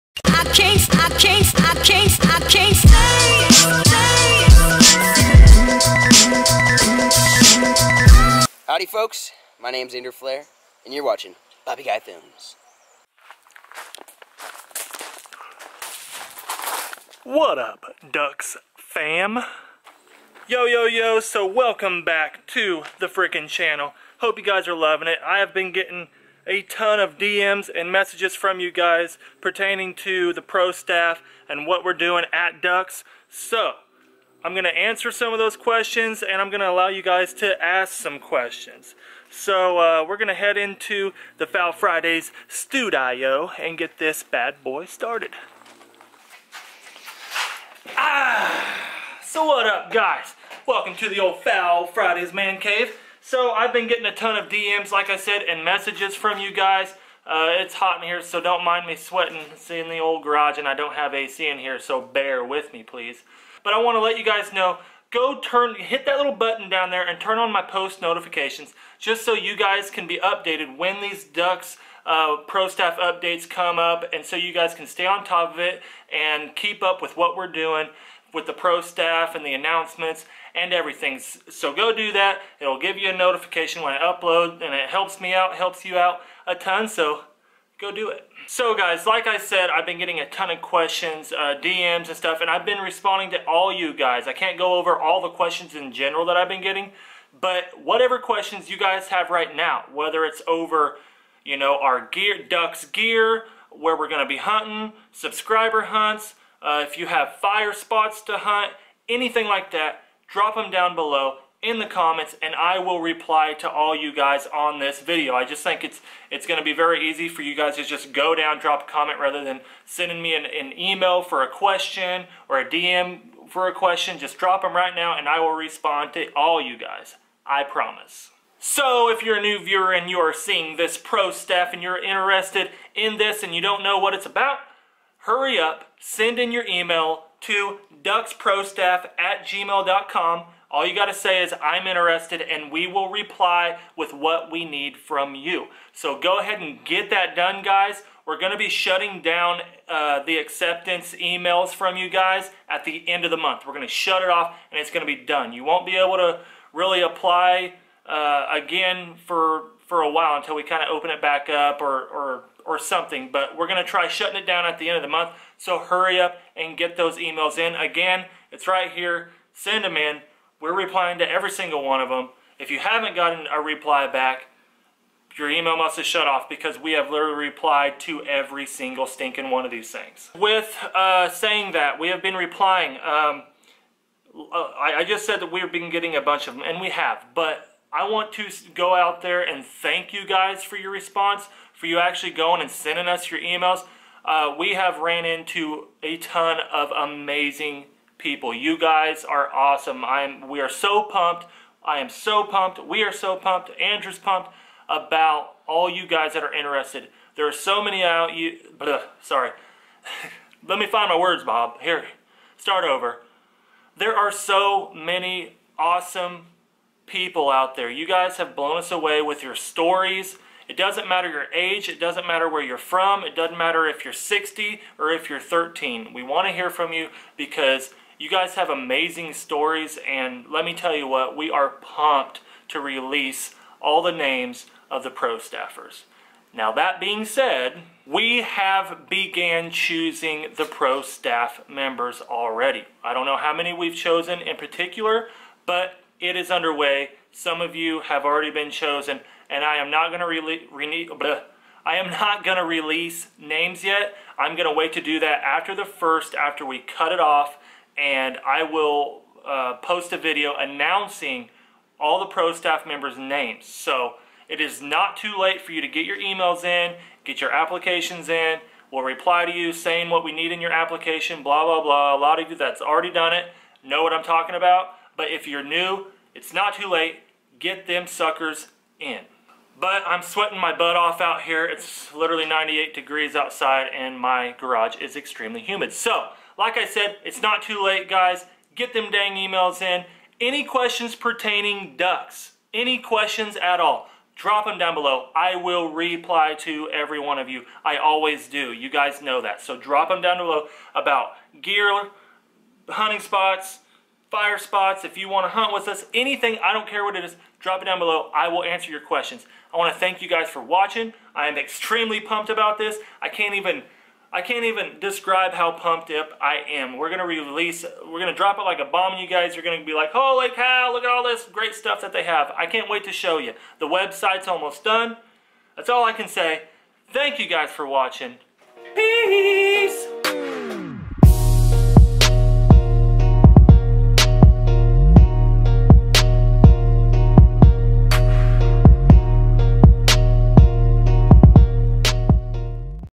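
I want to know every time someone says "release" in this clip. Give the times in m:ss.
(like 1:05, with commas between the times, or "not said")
3:52, 4:12, 5:17.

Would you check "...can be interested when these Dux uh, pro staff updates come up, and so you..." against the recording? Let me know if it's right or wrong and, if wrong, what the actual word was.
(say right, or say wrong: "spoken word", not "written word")
wrong: "updated", not "interested".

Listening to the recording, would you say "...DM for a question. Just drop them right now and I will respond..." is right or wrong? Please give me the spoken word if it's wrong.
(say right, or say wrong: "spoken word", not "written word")
right.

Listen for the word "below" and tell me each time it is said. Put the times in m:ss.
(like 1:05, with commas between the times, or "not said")
1:50, 4:54, 5:00, 5:07.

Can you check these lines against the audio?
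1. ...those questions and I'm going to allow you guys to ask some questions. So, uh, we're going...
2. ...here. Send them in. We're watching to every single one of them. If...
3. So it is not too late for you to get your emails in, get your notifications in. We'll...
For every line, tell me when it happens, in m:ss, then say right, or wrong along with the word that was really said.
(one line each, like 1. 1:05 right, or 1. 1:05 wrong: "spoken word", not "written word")
1. 0:35 right
2. 2:48 wrong: "replying", not "watching"
3. 4:23 wrong: "applications", not "notifications".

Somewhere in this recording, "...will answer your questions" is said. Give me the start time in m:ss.
5:08.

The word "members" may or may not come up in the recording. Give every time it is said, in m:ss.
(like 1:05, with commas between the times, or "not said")
4:01, 4:22.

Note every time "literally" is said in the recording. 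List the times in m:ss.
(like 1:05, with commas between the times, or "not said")
2:57, 4:42.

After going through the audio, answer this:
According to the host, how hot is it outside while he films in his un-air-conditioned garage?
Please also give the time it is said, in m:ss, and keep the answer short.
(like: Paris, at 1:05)
98 degrees, at 4:42.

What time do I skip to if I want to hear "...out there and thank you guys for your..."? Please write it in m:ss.
3:08.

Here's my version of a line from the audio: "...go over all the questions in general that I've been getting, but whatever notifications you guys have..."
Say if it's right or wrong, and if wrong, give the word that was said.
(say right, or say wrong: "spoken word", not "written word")
wrong: "questions", not "notifications".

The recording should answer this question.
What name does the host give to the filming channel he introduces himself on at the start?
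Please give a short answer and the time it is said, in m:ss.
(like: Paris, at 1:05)
Bobby Guy Films, at 0:11.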